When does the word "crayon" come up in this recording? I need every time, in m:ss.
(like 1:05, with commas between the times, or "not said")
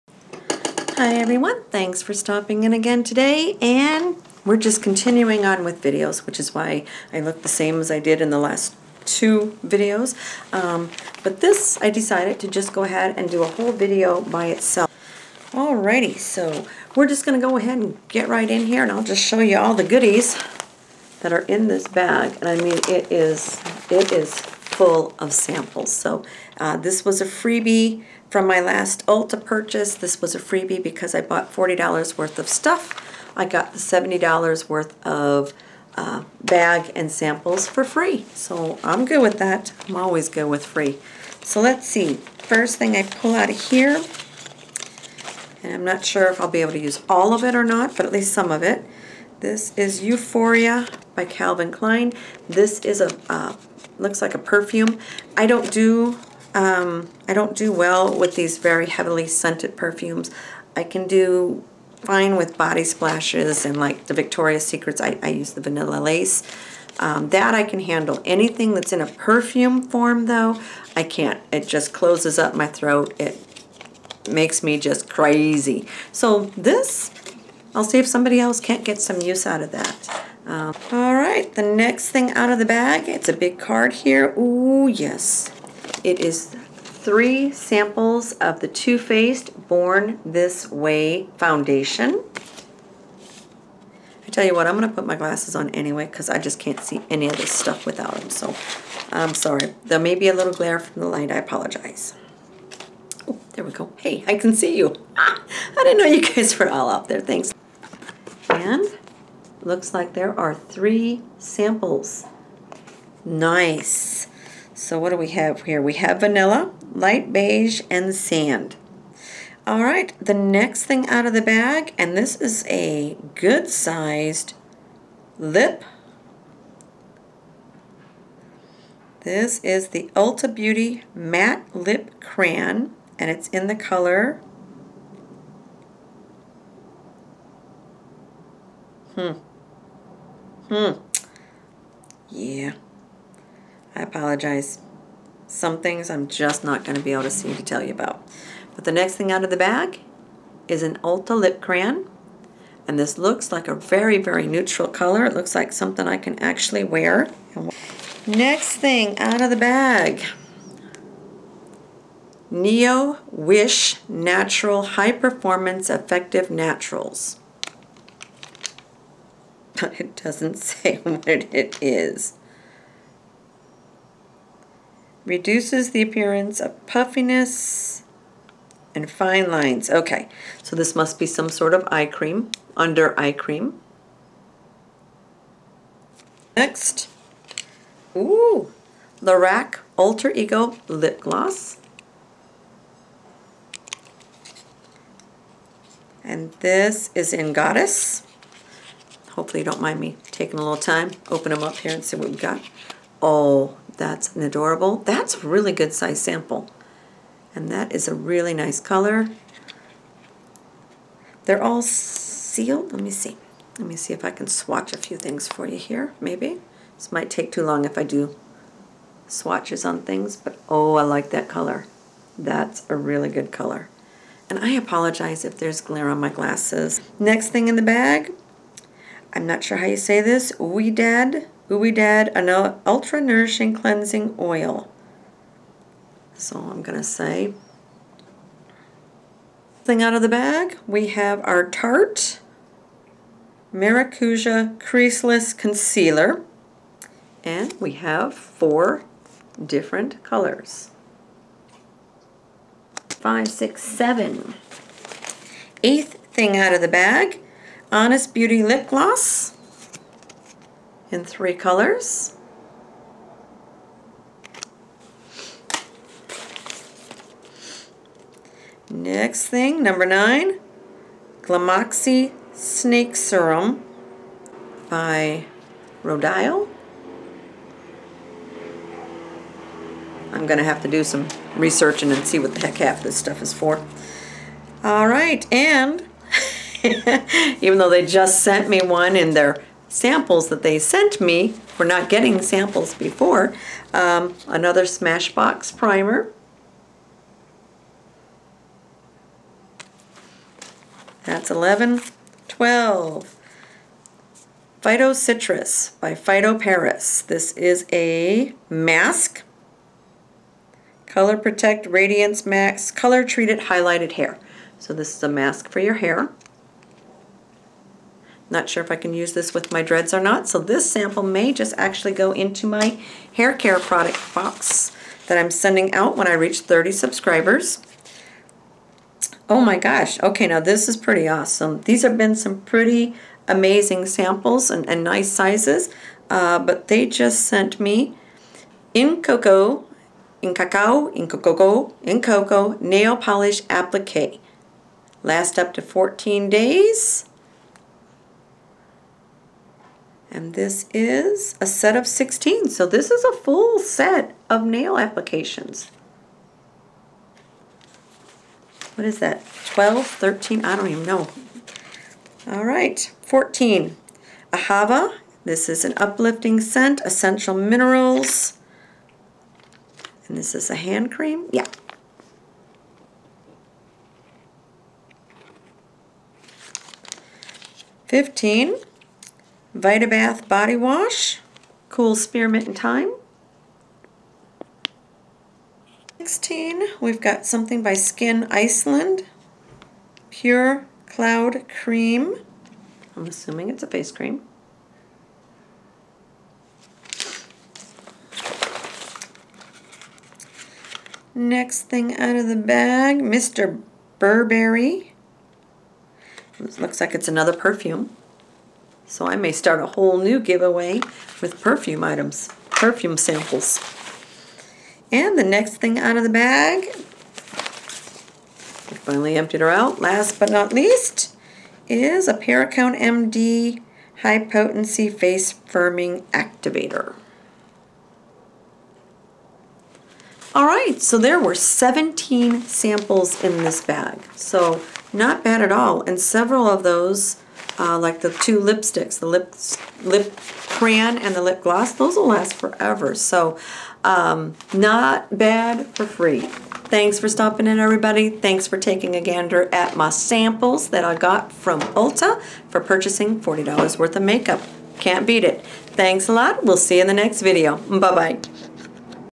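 2:12, 2:31, 7:20.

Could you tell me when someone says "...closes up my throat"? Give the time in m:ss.
1:11.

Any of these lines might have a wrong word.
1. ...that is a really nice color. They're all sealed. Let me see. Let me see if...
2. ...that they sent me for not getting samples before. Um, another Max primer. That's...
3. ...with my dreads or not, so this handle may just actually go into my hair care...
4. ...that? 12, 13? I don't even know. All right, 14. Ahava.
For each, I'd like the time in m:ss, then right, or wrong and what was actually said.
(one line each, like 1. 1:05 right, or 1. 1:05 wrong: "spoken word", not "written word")
1. 3:27 right
2. 4:50 wrong: "Smashbox", not "Max"
3. 5:19 wrong: "sample", not "handle"
4. 5:59 right.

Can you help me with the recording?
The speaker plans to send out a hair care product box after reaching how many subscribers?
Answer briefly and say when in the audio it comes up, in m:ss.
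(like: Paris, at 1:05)
30, at 5:26.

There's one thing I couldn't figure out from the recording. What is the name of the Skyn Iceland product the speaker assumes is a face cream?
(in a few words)
Pure Cloud Cream.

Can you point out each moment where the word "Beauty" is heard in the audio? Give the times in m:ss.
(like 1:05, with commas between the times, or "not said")
2:10, 4:18.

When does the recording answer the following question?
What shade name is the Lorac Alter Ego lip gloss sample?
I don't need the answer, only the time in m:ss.
3:17.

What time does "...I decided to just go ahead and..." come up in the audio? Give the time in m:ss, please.
0:11.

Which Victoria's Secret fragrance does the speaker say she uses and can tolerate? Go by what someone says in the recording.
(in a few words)
vanilla lace.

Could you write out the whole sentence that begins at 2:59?
Okay, so this must be some sort of eye cream, under eye cream.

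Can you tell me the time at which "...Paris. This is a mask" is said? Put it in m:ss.
5:06.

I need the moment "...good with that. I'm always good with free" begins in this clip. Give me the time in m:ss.
0:39.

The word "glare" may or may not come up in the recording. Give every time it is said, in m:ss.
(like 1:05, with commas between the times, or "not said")
1:40, 3:45.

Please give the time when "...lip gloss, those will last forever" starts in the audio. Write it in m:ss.
7:21.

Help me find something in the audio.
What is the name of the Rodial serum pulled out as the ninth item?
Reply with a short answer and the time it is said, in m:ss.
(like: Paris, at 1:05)
Glamoxy Snake Serum, at 4:31.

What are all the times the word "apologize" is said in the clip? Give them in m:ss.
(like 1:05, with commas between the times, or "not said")
1:41, 2:24, 3:44.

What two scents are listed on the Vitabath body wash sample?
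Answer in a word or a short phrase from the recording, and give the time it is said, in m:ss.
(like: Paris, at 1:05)
cool spearmint and thyme, at 6:21.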